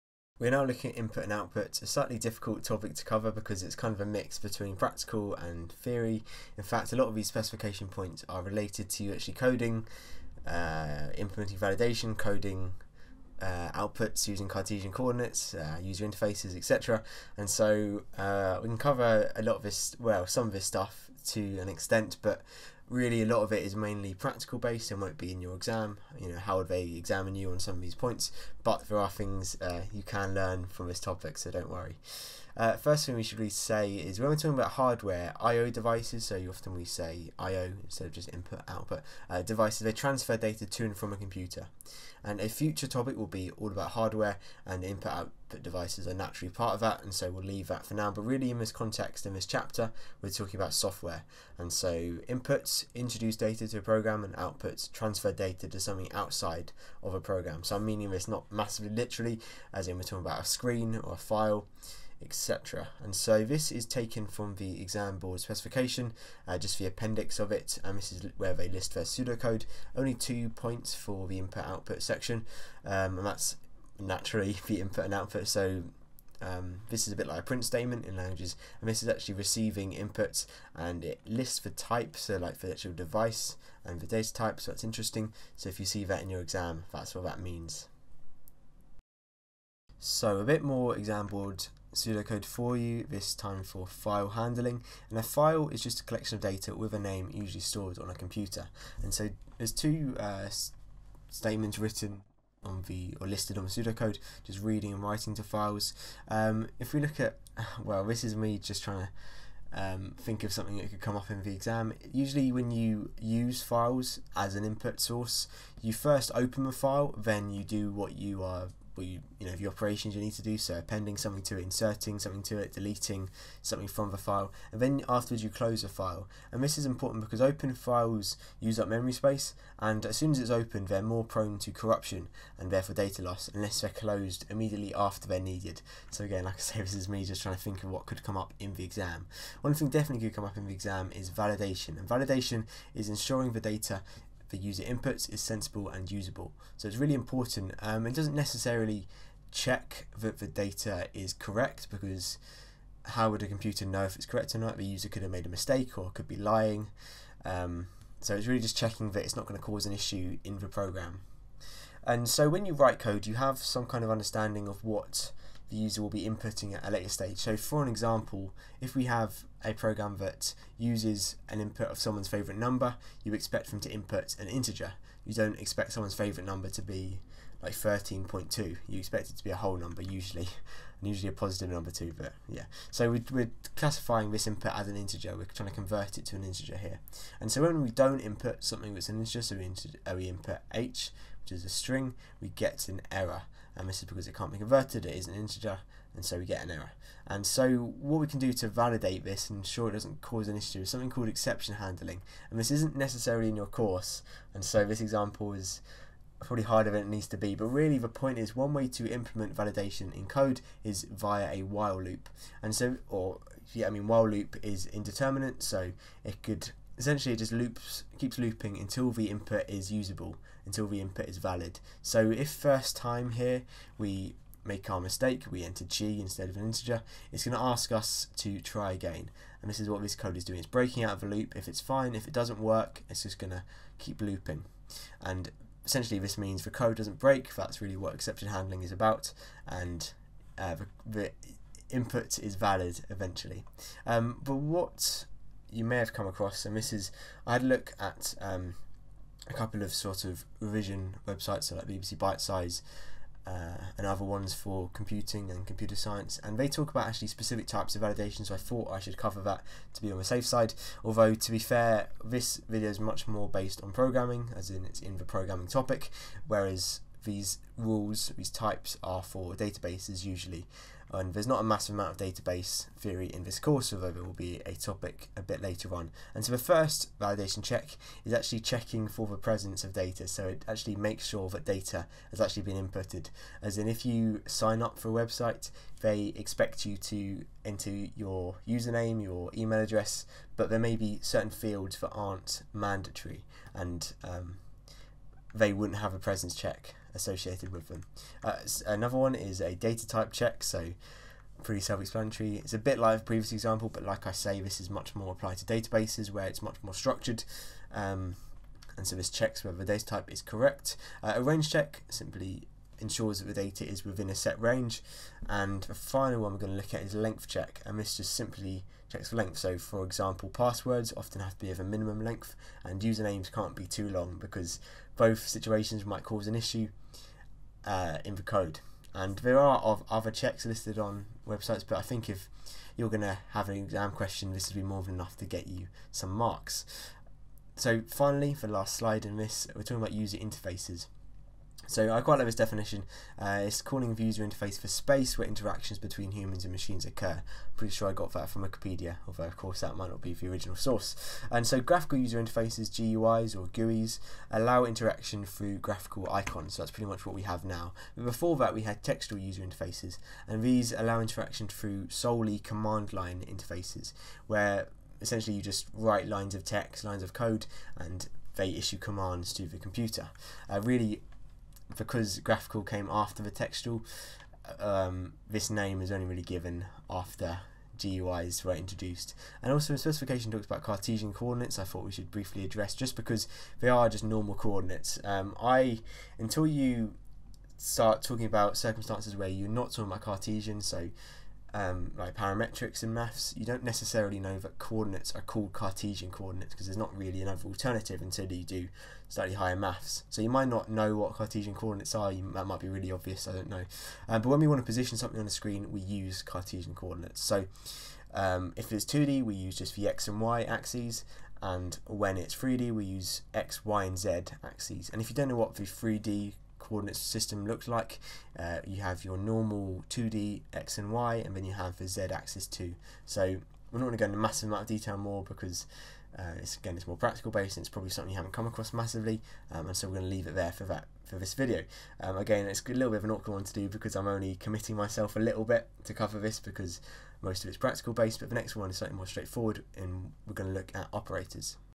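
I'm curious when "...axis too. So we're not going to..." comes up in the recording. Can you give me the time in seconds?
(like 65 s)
422 s.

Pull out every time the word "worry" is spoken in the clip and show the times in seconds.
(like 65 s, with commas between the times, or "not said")
31 s.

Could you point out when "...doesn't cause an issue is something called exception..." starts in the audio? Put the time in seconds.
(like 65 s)
199 s.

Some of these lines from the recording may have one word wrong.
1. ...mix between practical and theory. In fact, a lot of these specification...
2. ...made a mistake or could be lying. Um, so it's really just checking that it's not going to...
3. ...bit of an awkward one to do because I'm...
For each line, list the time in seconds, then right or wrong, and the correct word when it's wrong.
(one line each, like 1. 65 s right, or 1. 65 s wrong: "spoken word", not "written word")
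1. 4 s right
2. 155 s right
3. 433 s right.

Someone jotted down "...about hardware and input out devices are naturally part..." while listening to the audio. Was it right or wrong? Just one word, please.
right.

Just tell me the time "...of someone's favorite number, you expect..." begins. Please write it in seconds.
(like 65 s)
171 s.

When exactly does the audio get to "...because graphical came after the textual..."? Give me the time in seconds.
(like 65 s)
371 s.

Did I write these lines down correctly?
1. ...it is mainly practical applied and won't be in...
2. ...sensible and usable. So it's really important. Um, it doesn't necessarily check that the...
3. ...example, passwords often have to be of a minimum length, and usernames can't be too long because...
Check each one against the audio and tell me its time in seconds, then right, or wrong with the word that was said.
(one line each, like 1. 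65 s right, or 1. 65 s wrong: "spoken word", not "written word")
1. 23 s wrong: "based", not "applied"
2. 145 s right
3. 320 s right.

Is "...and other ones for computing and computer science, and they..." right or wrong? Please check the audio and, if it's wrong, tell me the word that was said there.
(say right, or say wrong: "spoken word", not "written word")
right.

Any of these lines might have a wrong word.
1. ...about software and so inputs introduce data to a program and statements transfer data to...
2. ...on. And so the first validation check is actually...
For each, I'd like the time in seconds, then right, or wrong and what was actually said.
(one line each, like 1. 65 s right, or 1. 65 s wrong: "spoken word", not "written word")
1. 50 s wrong: "outputs", not "statements"
2. 275 s right.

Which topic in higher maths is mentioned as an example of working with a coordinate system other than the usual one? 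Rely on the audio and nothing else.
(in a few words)
parametrics.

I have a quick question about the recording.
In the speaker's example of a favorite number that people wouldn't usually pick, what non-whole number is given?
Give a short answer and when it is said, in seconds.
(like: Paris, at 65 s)
13.2, at 177 s.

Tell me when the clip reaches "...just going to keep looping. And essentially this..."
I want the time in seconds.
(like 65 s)
233 s.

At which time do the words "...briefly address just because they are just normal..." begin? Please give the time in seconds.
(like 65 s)
382 s.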